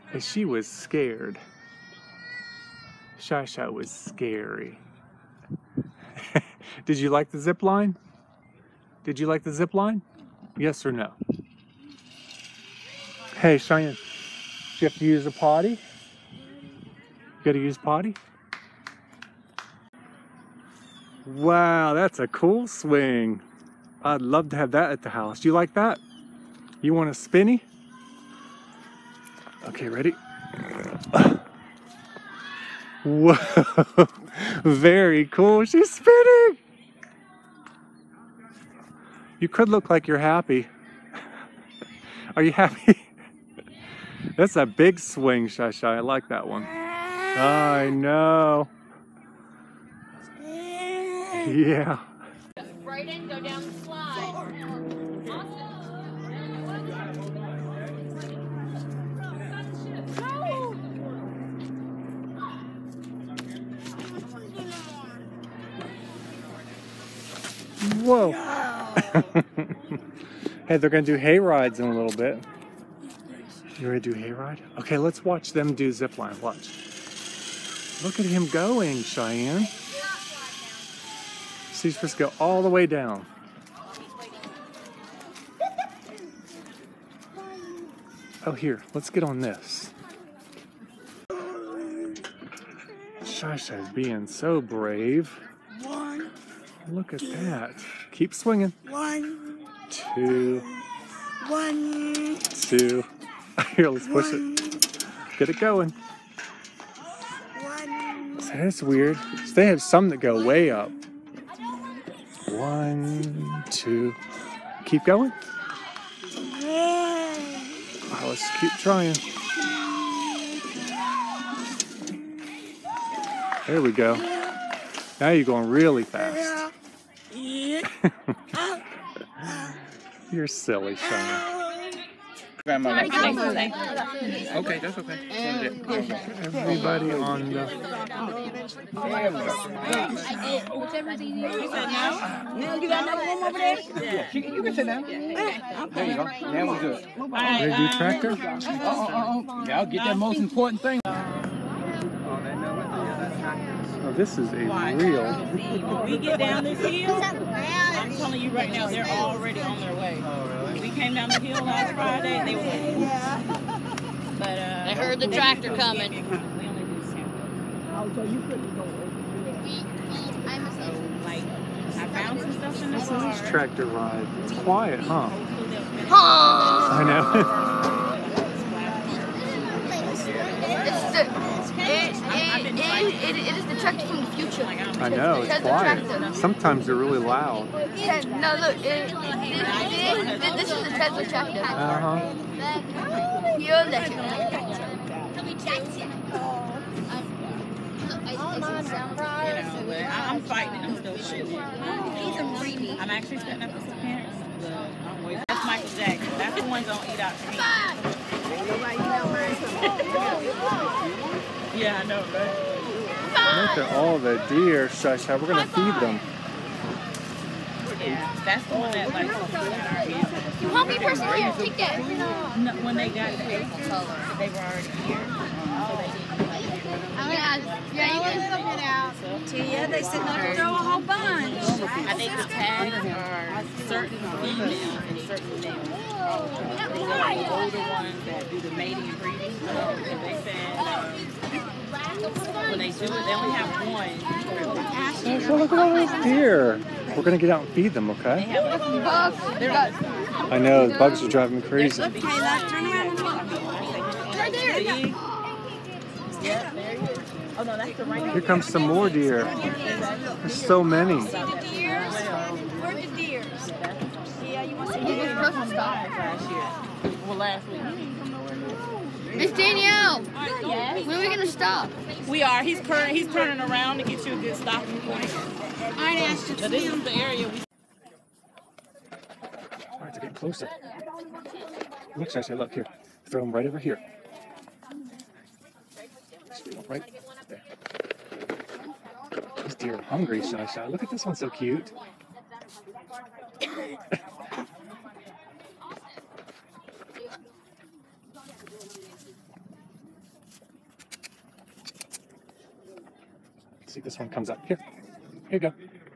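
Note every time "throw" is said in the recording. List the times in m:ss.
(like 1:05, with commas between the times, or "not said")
3:50, 4:43.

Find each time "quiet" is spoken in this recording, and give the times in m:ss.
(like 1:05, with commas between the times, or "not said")
2:54, 3:05.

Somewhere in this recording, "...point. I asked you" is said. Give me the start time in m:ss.
4:35.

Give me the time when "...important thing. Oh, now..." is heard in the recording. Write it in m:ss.
2:30.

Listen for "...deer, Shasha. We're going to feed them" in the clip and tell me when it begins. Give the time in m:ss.
3:34.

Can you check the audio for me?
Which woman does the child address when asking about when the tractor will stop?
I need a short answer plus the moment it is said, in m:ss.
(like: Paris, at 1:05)
Miss Danielle, at 4:29.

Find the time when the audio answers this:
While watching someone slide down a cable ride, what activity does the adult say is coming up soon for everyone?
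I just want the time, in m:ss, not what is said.
1:11.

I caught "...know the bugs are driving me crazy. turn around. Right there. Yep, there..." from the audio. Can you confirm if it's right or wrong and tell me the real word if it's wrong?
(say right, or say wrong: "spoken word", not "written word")
right.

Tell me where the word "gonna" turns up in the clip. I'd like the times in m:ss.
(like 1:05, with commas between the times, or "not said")
3:26, 4:07, 4:31.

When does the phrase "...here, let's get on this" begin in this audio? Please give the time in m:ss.
1:28.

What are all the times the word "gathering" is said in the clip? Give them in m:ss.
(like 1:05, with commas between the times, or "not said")
not said.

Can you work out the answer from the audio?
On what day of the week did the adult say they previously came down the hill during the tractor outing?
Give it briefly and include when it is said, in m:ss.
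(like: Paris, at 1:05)
Friday, at 2:41.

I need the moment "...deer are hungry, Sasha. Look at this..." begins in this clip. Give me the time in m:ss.
4:49.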